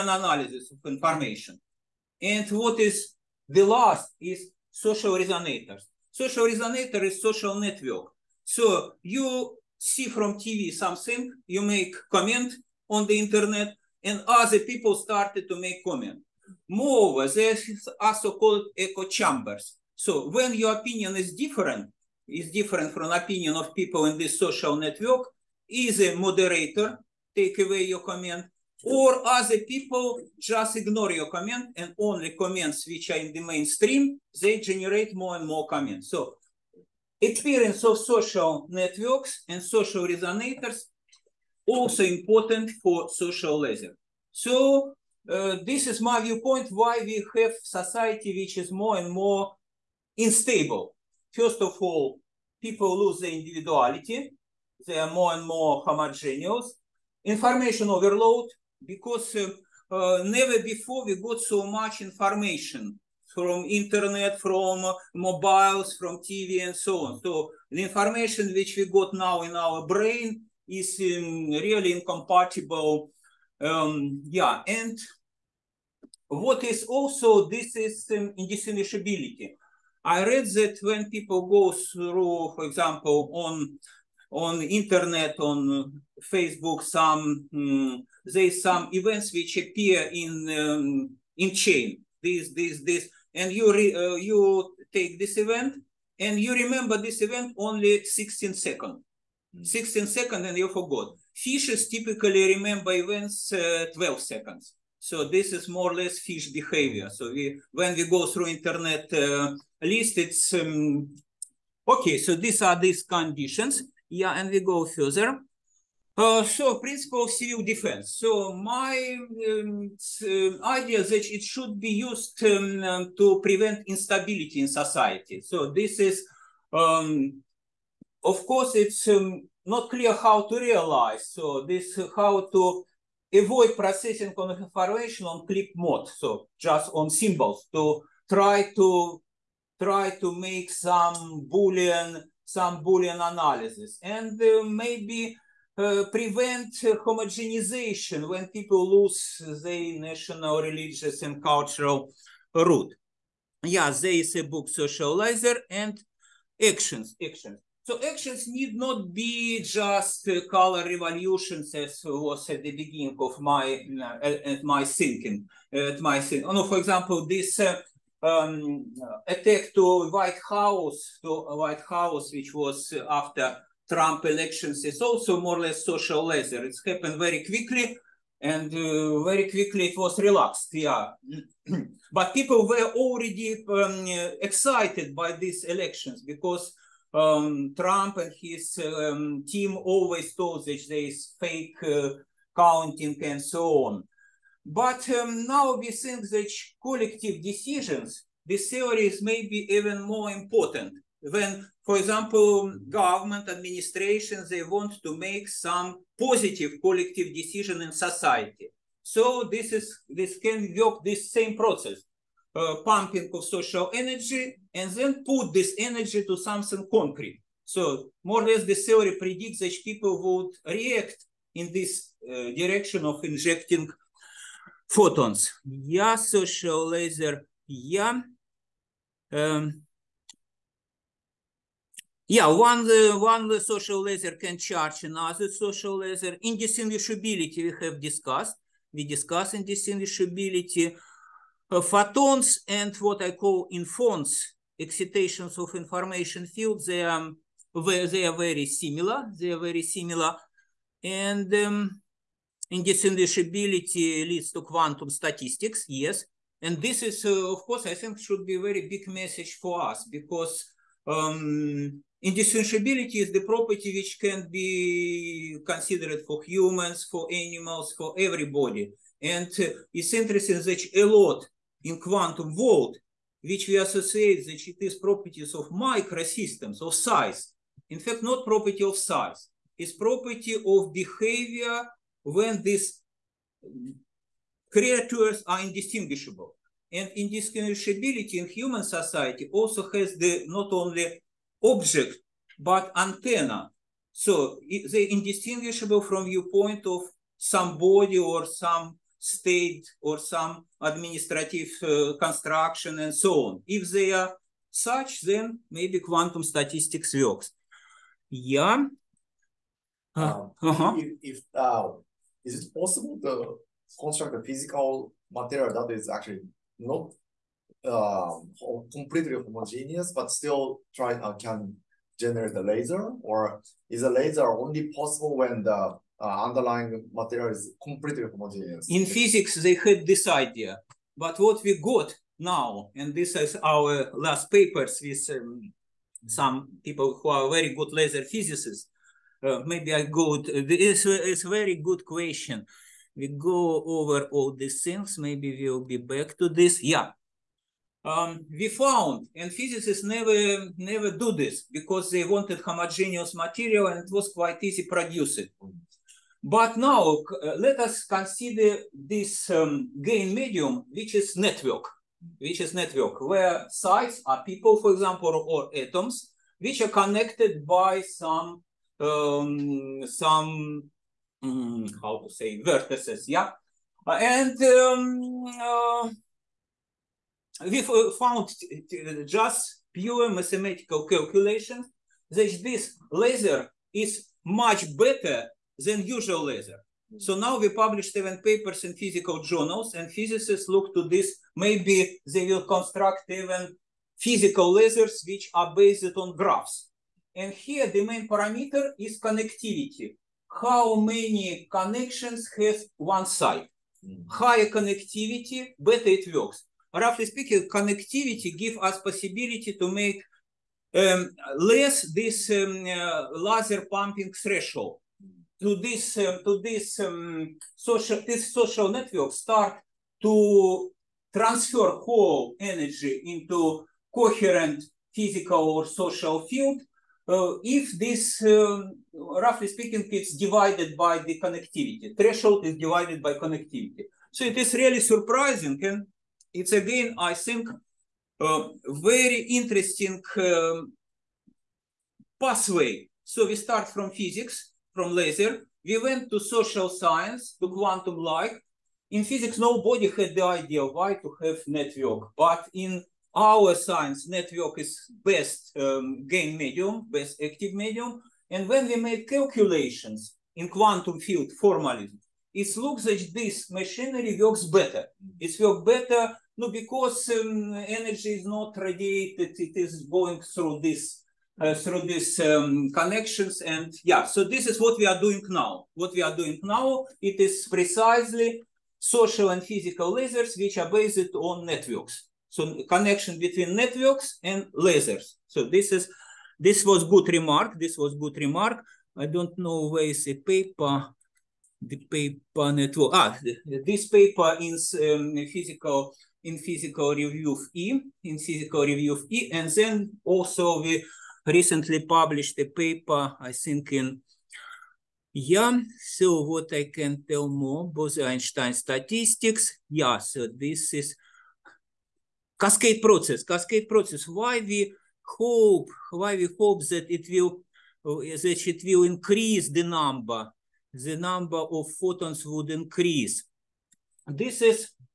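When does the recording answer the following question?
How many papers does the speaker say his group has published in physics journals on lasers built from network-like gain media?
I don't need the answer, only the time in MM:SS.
06:28.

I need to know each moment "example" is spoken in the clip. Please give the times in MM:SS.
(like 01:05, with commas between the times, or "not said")
01:22, 02:46, 03:21, 06:04.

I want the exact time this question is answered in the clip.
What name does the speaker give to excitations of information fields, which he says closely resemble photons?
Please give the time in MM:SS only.
04:03.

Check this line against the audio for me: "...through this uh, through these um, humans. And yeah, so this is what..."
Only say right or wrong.
wrong.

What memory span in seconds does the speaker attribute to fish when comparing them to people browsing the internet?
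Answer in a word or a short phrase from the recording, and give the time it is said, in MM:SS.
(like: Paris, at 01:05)
12 seconds, at 01:43.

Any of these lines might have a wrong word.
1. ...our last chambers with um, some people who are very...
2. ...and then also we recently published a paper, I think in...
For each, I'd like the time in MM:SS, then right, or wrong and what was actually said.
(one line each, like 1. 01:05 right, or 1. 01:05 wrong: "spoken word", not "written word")
1. 05:33 wrong: "papers", not "chambers"
2. 08:19 right.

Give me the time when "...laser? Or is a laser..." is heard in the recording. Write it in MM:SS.
05:22.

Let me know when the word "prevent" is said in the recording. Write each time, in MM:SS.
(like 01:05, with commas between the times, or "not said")
02:03, 02:26.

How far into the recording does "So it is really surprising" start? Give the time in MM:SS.
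07:14.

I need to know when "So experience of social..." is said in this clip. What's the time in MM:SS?
00:36.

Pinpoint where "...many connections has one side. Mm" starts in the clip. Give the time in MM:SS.
06:40.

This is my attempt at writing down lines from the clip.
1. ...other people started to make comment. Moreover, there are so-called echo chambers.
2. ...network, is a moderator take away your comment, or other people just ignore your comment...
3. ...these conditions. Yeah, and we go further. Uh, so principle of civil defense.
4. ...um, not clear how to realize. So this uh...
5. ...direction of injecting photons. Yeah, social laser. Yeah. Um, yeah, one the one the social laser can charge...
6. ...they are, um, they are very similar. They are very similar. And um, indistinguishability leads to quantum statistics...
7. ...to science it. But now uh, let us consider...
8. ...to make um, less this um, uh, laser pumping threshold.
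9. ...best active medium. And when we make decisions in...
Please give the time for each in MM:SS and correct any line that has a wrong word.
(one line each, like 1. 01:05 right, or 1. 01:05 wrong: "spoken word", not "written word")
1. 00:14 right
2. 00:24 right
3. 01:52 right
4. 02:09 right
5. 03:42 right
6. 04:06 right
7. 05:54 wrong: "produce", not "science"
8. 06:49 right
9. 07:37 wrong: "calculations", not "decisions".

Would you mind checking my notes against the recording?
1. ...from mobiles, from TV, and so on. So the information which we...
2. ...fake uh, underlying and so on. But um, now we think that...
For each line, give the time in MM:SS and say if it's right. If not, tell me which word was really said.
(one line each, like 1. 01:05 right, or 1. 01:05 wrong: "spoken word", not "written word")
1. 01:04 right
2. 03:11 wrong: "counting", not "underlying".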